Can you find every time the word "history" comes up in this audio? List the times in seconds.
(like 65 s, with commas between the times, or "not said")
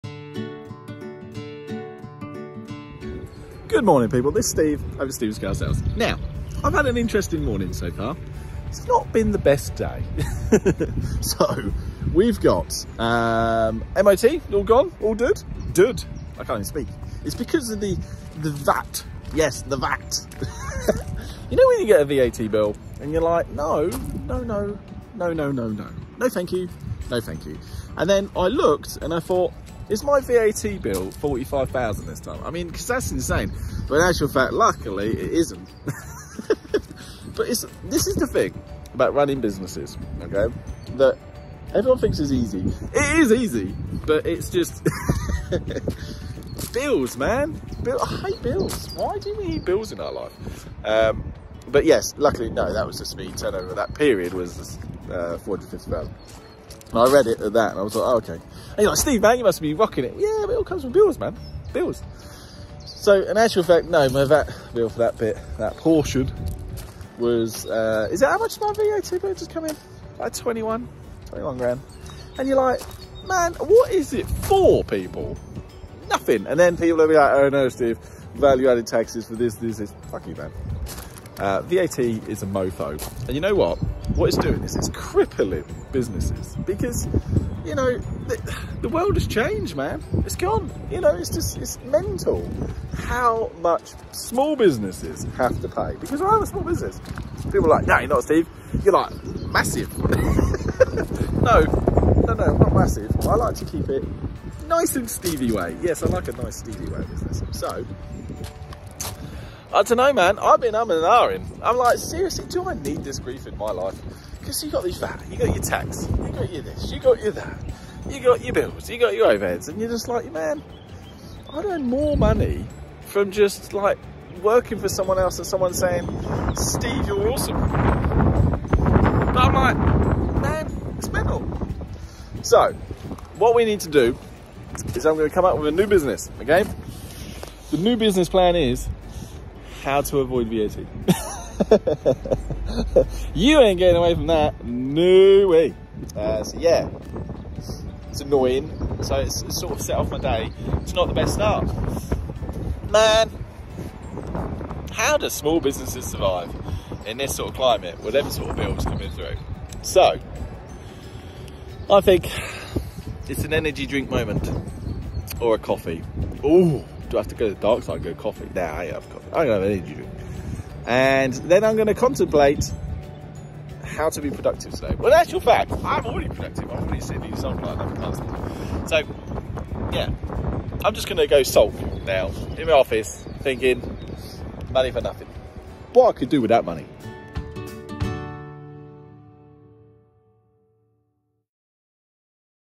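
not said.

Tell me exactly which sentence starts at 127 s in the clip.
But I'm like, man, it's mental.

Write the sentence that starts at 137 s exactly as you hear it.
The new business plan is how to avoid VAT.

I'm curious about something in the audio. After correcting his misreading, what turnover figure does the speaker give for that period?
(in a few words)
450,000.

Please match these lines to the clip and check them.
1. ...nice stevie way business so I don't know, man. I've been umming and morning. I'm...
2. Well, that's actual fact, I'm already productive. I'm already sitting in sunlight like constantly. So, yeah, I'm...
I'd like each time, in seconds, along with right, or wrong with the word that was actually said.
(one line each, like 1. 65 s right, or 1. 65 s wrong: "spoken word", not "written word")
1. 106 s wrong: "ahhing", not "morning"
2. 174 s right.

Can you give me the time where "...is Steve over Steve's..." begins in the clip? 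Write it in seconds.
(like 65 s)
4 s.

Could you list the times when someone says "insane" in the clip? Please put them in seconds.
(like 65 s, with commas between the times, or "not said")
33 s.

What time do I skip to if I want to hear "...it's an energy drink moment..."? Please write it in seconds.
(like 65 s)
163 s.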